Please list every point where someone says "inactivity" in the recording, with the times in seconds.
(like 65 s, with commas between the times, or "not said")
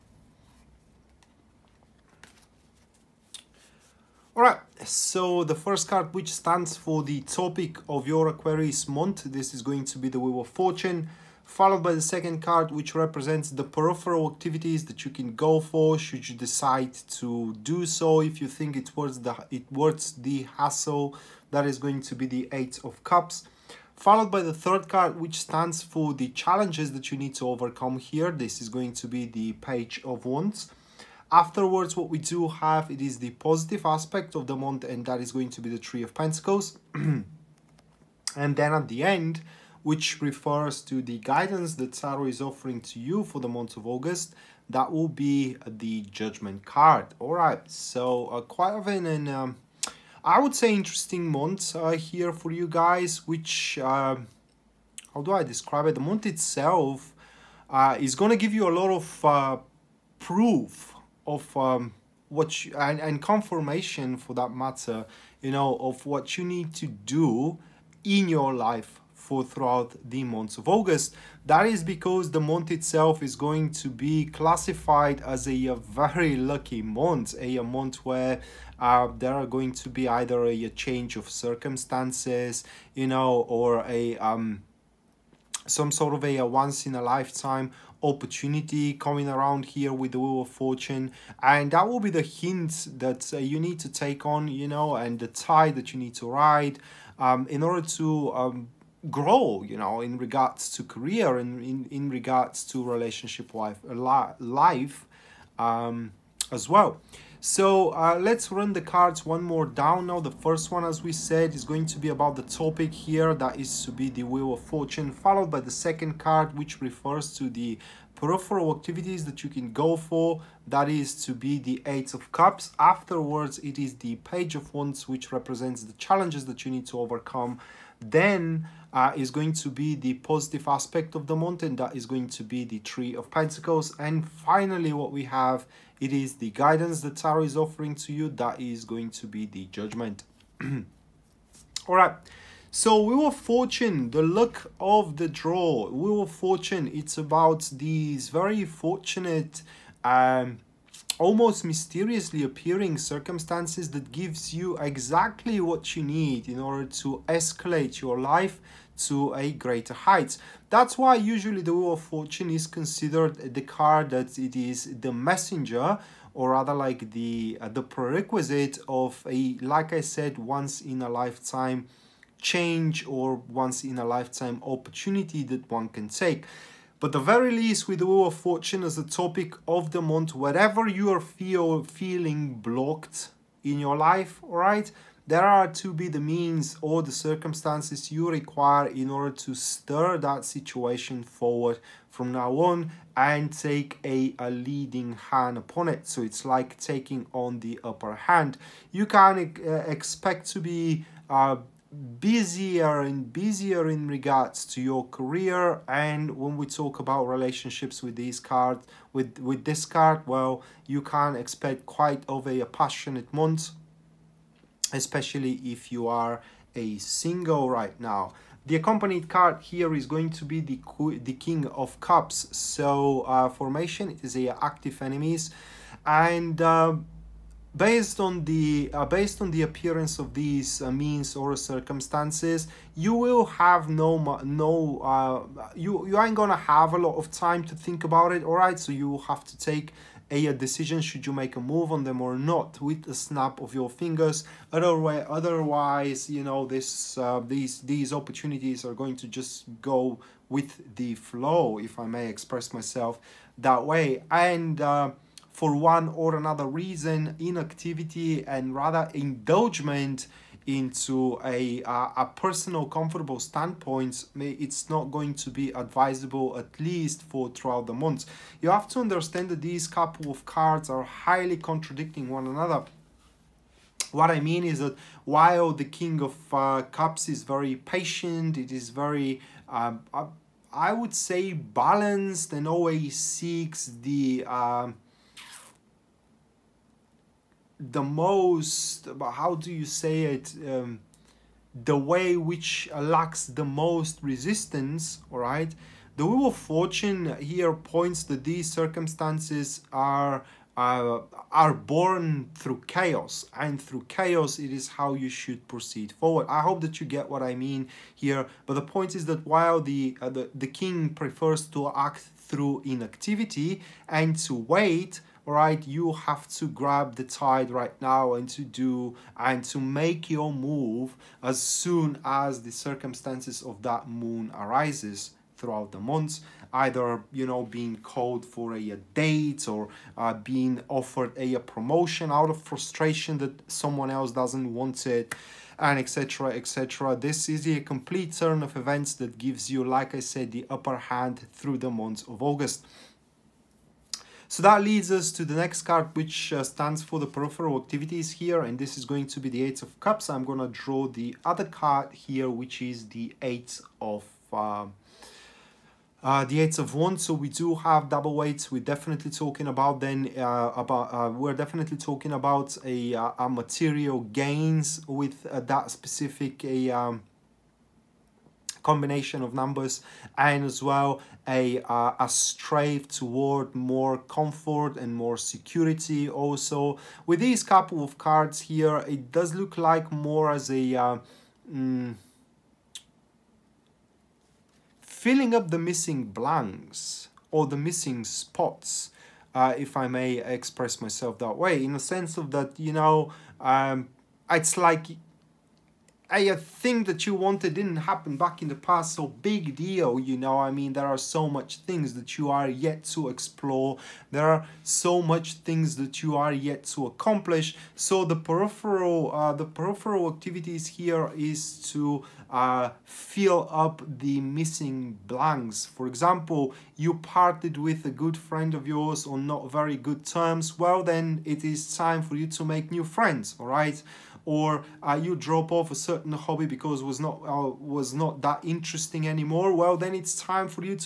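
257 s, 312 s.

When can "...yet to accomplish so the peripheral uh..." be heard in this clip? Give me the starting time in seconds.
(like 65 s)
406 s.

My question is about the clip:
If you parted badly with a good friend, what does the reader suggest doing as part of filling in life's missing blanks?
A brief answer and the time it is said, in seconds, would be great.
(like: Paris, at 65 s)
make new friends, at 422 s.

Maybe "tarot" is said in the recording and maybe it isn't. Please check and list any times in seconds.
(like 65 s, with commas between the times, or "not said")
41 s, 137 s.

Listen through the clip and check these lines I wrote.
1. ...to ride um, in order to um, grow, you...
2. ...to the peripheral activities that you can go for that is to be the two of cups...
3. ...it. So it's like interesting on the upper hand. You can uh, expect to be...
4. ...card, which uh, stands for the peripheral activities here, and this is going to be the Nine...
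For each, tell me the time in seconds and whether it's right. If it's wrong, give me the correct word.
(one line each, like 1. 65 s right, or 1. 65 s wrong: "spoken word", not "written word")
1. 96 s right
2. 117 s wrong: "eight", not "two"
3. 195 s wrong: "taking", not "interesting"
4. 345 s wrong: "Eight", not "Nine".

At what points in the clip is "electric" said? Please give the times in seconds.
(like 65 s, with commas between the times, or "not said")
not said.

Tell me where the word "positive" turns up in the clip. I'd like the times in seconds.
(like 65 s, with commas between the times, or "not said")
33 s, 130 s.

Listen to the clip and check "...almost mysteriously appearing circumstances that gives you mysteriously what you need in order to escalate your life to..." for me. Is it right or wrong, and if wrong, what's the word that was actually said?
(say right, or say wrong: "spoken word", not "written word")
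wrong: "exactly", not "mysteriously".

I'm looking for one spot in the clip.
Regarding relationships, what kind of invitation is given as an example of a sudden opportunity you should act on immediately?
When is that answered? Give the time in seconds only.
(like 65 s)
328 s.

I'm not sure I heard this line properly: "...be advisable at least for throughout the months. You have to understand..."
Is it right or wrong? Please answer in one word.
right.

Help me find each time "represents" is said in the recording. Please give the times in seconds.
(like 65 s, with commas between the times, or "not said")
12 s, 125 s.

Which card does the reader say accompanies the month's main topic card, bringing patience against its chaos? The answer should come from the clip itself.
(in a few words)
King of Cups.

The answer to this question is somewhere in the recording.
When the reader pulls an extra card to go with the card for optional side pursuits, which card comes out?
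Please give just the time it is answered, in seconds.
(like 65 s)
356 s.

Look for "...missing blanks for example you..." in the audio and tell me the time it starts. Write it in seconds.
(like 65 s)
414 s.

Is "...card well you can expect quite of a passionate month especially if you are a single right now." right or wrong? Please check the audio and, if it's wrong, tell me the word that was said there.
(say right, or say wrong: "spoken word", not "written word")
right.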